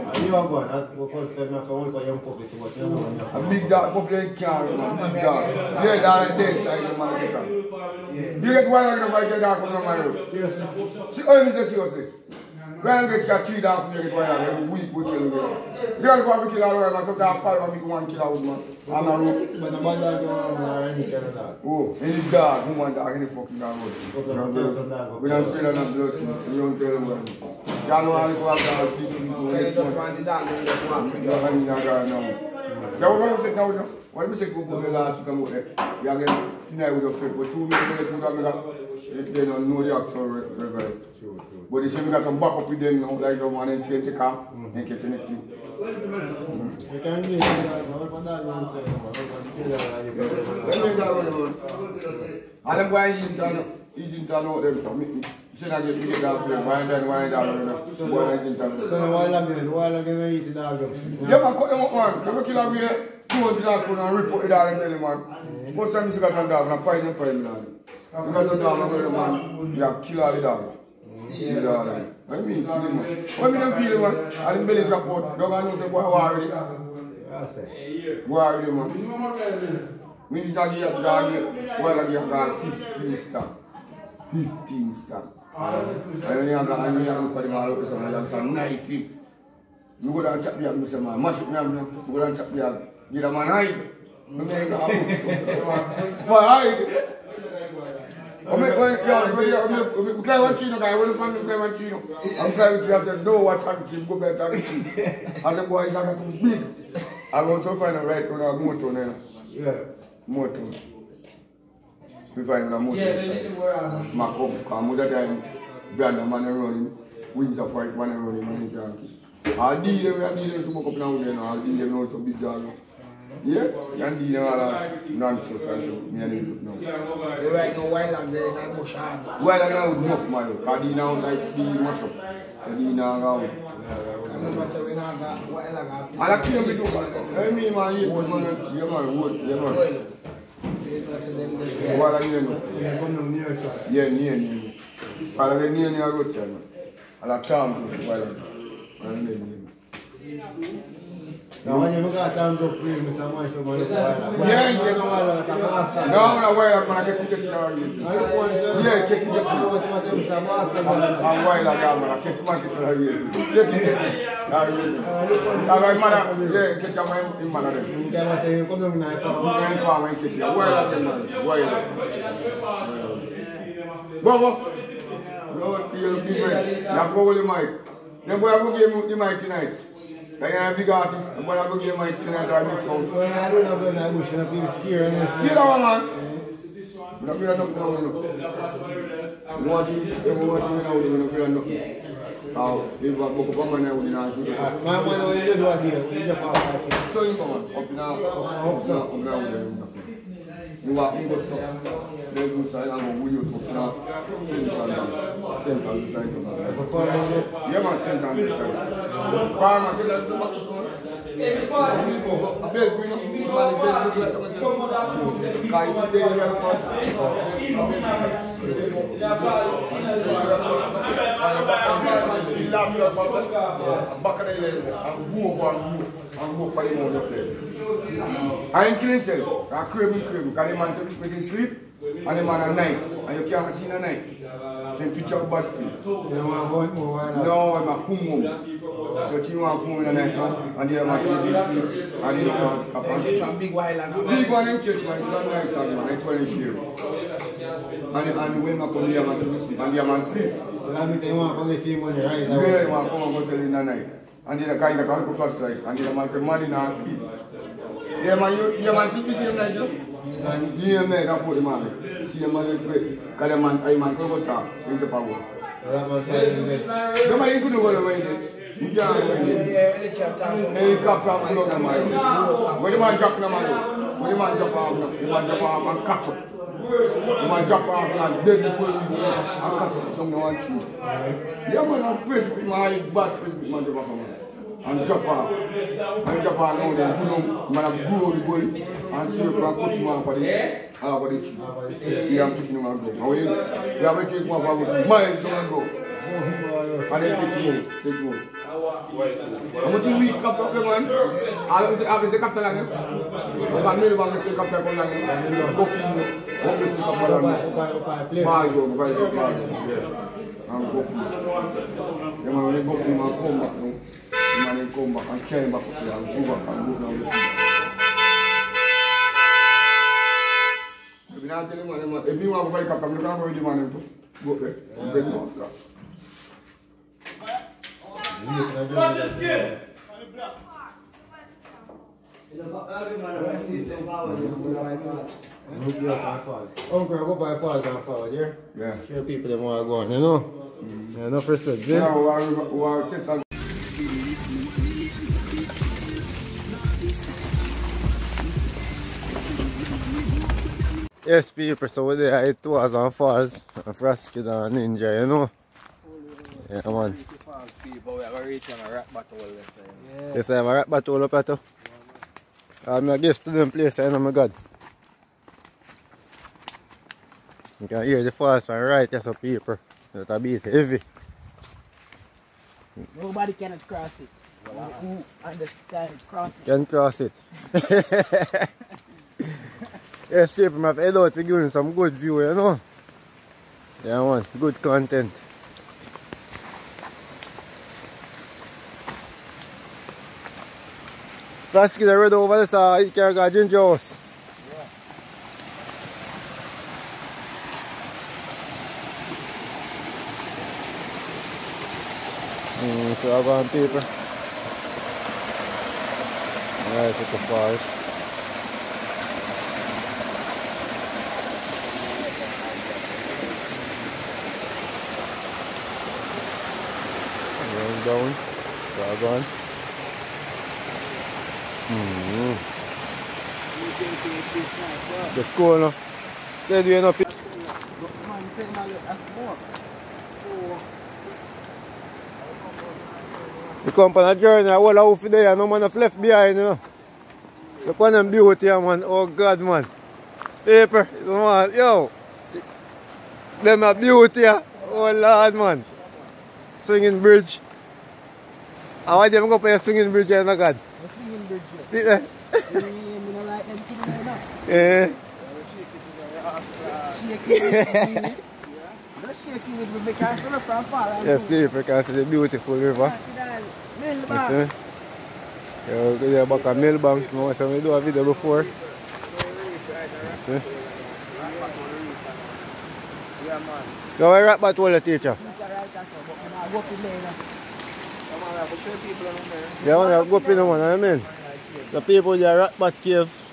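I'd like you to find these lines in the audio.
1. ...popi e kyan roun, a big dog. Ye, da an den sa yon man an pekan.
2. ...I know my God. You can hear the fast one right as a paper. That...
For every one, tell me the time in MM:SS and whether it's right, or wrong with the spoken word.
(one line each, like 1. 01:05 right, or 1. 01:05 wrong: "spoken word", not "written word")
1. 00:03 right
2. 06:03 right.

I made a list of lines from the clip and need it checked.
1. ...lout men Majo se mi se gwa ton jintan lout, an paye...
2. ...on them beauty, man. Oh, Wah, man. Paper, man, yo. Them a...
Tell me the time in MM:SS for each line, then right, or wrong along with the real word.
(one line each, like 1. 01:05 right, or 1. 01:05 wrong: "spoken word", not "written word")
1. 01:05 wrong: "Bwè", not "Majo"
2. 07:18 wrong: "God", not "Wah".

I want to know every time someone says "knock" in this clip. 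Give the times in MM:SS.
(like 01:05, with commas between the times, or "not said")
03:08, 03:14.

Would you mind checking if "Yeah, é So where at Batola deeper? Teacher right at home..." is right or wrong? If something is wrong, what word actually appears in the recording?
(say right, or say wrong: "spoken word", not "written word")
wrong: "teacher", not "deeper".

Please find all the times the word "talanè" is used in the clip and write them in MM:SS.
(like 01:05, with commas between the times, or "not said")
05:02, 05:07.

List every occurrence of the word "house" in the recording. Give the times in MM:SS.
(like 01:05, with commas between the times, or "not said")
07:14.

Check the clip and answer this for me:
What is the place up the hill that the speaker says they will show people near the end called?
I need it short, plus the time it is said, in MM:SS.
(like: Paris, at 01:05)
Bat Cave, at 08:02.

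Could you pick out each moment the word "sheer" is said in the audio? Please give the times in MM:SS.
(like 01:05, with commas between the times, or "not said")
not said.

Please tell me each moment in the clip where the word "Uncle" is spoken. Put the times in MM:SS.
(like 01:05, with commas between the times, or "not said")
05:28.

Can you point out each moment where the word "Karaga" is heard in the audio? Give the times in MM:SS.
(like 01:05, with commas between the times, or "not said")
06:33.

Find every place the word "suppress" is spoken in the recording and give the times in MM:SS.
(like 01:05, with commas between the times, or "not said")
not said.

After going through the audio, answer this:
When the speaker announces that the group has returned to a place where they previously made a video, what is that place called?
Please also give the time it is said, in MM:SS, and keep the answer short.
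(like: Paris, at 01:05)
Millbank, at 07:46.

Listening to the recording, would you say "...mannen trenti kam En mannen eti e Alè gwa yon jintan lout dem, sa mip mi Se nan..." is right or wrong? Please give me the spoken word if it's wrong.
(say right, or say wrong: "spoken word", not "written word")
wrong: "keten", not "mannen".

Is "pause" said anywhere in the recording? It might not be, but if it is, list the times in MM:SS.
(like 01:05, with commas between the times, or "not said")
05:37.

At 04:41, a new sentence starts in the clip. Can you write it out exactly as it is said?
Yaman an prejipi mwen an yek bat prejipi mwen japa ap man.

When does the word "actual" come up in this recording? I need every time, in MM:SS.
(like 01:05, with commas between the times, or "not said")
00:40.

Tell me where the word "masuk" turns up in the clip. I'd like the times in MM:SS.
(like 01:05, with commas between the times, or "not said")
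01:31, 02:11.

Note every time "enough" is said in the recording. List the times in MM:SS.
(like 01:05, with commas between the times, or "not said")
00:24, 05:41.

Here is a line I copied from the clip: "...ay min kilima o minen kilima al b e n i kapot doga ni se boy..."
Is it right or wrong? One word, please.
right.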